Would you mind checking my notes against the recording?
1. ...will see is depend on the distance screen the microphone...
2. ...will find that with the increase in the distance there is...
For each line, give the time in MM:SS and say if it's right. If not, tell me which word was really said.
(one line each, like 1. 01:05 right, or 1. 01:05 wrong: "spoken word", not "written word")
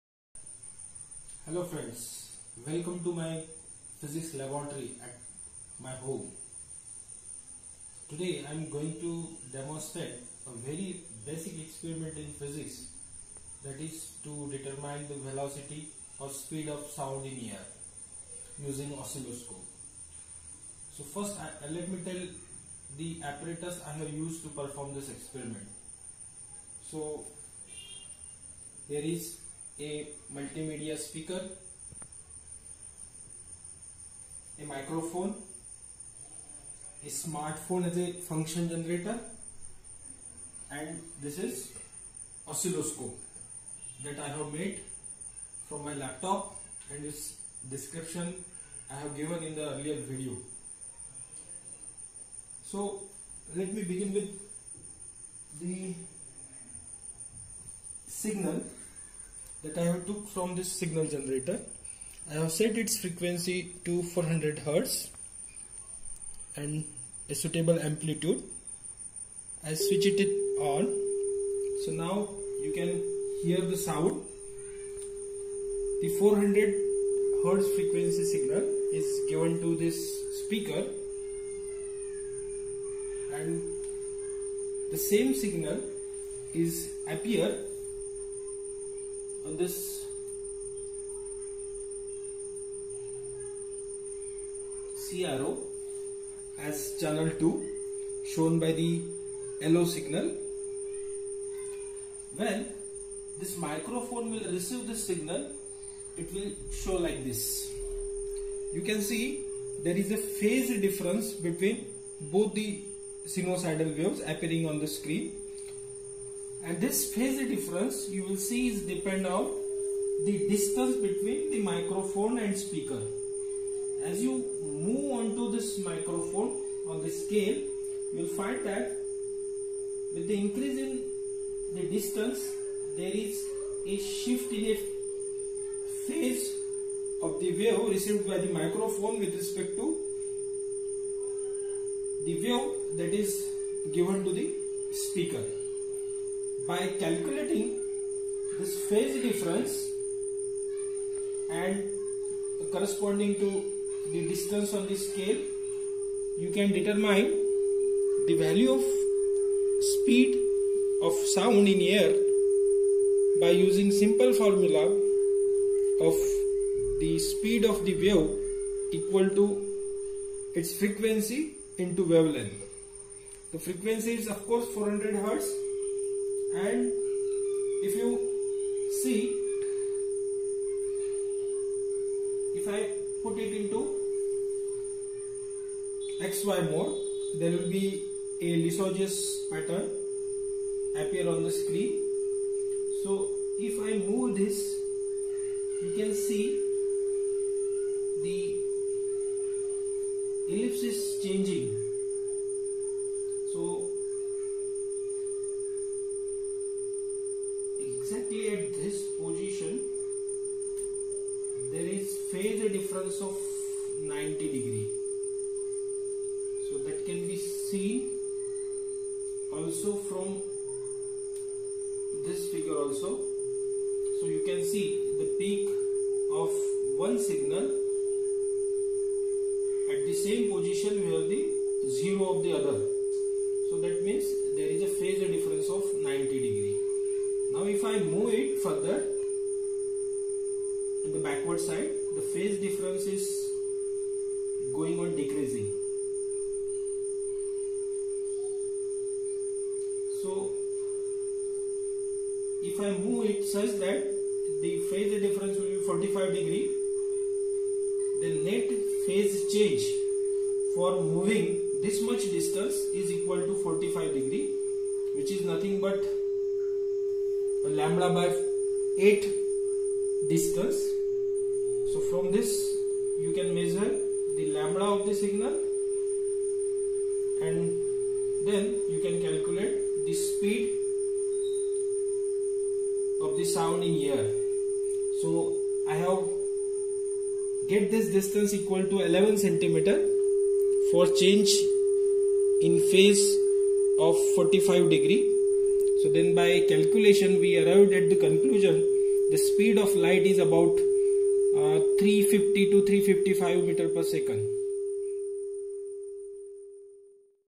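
1. 01:58 wrong: "between", not "screen"
2. 02:08 right.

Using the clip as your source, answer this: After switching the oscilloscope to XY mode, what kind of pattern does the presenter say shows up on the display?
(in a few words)
Lissajous pattern.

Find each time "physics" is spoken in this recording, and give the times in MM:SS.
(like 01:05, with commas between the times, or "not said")
00:03, 00:12.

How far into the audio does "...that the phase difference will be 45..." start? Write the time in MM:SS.
04:13.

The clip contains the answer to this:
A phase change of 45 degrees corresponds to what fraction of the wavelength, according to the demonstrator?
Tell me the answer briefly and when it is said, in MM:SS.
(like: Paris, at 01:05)
Lambda by 8, at 04:27.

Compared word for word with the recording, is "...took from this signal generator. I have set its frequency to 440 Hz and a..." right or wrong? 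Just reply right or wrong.
wrong.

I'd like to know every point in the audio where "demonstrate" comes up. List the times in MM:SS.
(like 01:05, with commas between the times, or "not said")
00:09.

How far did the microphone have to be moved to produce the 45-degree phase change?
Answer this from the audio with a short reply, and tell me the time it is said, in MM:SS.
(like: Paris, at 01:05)
11 centimeters, at 04:49.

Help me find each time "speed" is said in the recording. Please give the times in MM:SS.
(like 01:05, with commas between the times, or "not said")
00:16, 02:39, 02:47, 04:40, 04:59.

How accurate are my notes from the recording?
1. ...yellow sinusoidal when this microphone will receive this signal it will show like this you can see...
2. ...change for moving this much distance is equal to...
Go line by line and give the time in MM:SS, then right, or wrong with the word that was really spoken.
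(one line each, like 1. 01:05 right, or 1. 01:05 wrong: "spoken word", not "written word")
1. 01:39 wrong: "signal", not "sinusoidal"
2. 04:19 right.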